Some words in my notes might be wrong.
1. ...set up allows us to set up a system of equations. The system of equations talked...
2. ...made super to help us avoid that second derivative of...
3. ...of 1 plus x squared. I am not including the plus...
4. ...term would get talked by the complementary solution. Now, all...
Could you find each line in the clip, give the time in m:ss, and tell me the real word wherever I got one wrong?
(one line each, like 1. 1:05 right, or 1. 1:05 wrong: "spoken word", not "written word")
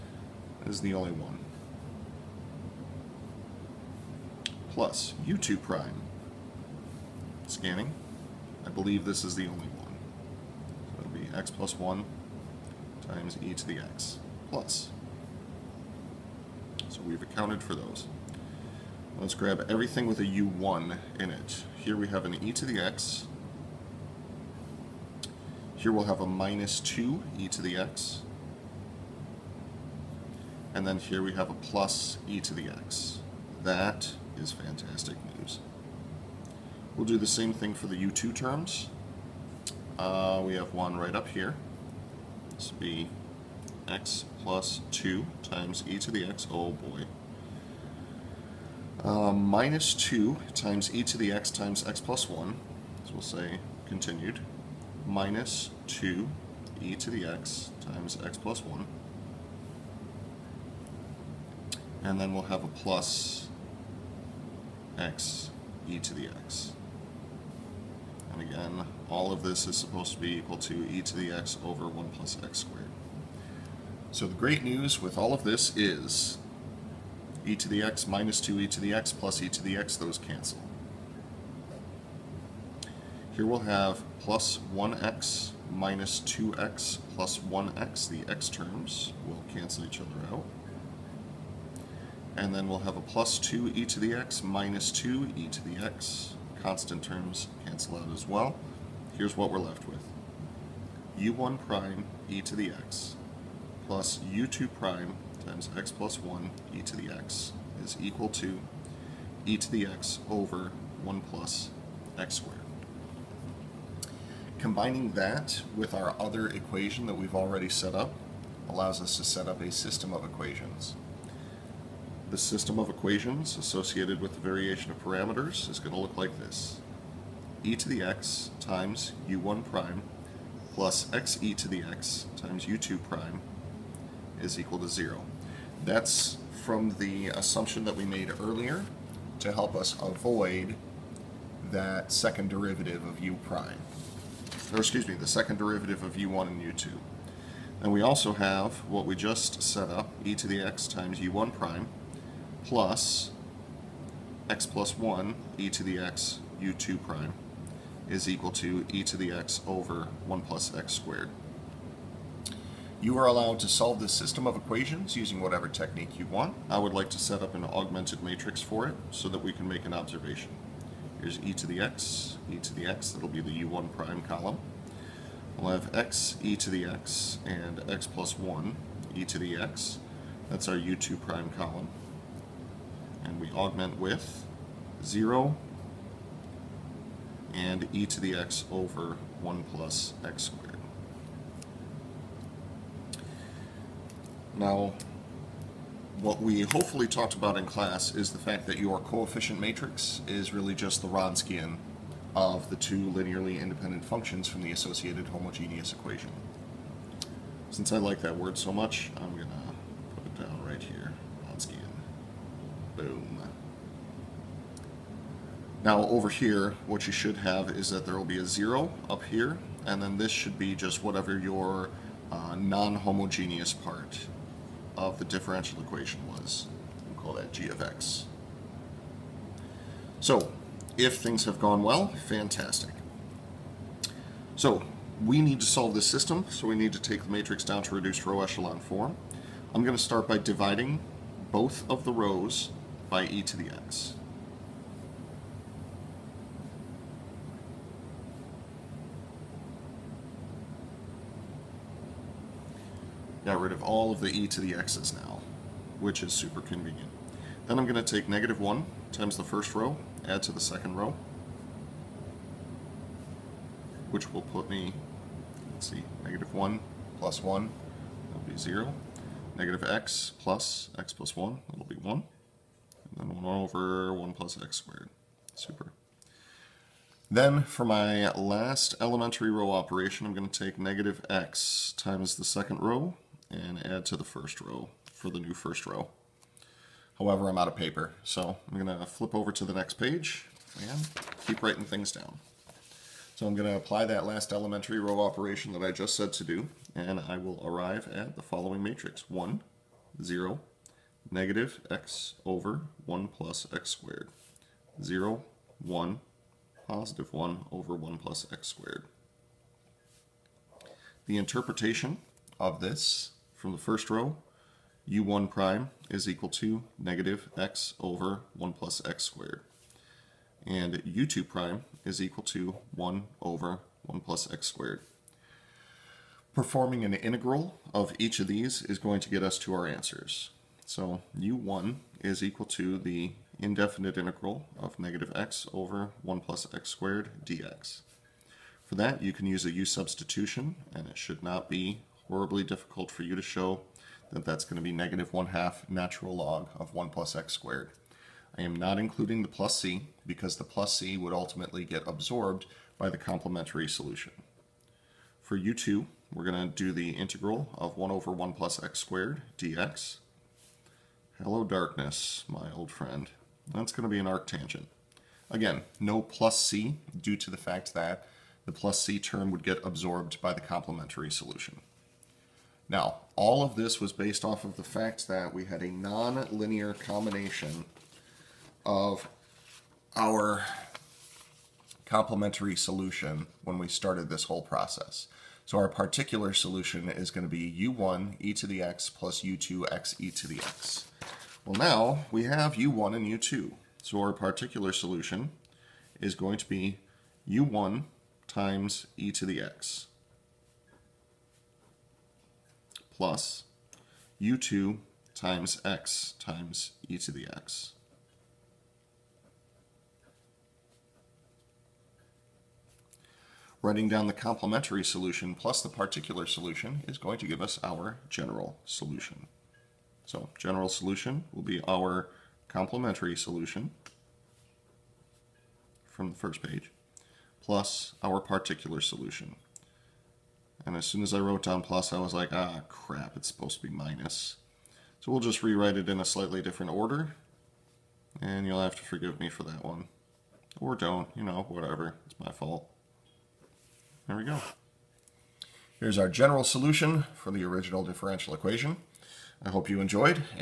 1. 1:57 wrong: "associated", not "talked"
2. 2:18 wrong: "earlier", not "super"
3. 5:46 right
4. 6:09 wrong: "absorbed", not "talked".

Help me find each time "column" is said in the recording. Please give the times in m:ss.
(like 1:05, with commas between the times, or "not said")
2:54, 3:01.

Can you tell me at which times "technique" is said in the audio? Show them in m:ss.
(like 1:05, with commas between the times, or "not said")
2:45.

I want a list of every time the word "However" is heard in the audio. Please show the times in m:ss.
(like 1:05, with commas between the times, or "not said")
4:47.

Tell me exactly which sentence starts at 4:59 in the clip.
1, 0, negative x over 1 plus x squared.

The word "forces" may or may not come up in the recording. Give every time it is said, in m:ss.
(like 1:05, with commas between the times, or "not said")
not said.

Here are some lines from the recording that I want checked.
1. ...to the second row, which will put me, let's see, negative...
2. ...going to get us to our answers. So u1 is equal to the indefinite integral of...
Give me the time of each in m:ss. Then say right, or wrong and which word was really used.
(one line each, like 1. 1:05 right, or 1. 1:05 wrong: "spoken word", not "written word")
1. 4:20 right
2. 5:28 right.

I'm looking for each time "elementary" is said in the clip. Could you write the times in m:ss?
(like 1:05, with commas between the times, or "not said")
4:38, 4:54.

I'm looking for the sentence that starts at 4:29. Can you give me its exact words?
Negative x plus x plus 1, that'll be 1 then 1 over 1 plus x squared.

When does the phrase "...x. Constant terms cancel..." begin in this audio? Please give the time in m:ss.
1:35.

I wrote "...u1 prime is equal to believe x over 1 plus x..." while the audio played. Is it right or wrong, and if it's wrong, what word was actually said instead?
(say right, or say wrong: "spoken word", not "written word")
wrong: "negative", not "believe".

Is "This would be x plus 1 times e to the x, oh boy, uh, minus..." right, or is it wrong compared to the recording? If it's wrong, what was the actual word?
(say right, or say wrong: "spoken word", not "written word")
wrong: "2", not "1".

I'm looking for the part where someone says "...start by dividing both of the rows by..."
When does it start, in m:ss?
4:00.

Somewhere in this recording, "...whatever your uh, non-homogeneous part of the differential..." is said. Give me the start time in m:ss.
3:41.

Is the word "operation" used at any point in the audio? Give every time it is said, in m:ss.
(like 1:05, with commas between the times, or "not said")
4:39, 4:55.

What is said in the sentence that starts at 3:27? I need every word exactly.
Since I like that word so much, I'm going to put it down right here.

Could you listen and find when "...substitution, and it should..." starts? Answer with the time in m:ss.
5:39.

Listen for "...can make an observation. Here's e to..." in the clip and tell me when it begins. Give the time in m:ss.
2:49.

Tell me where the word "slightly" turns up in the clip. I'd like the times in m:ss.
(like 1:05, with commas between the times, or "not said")
7:16.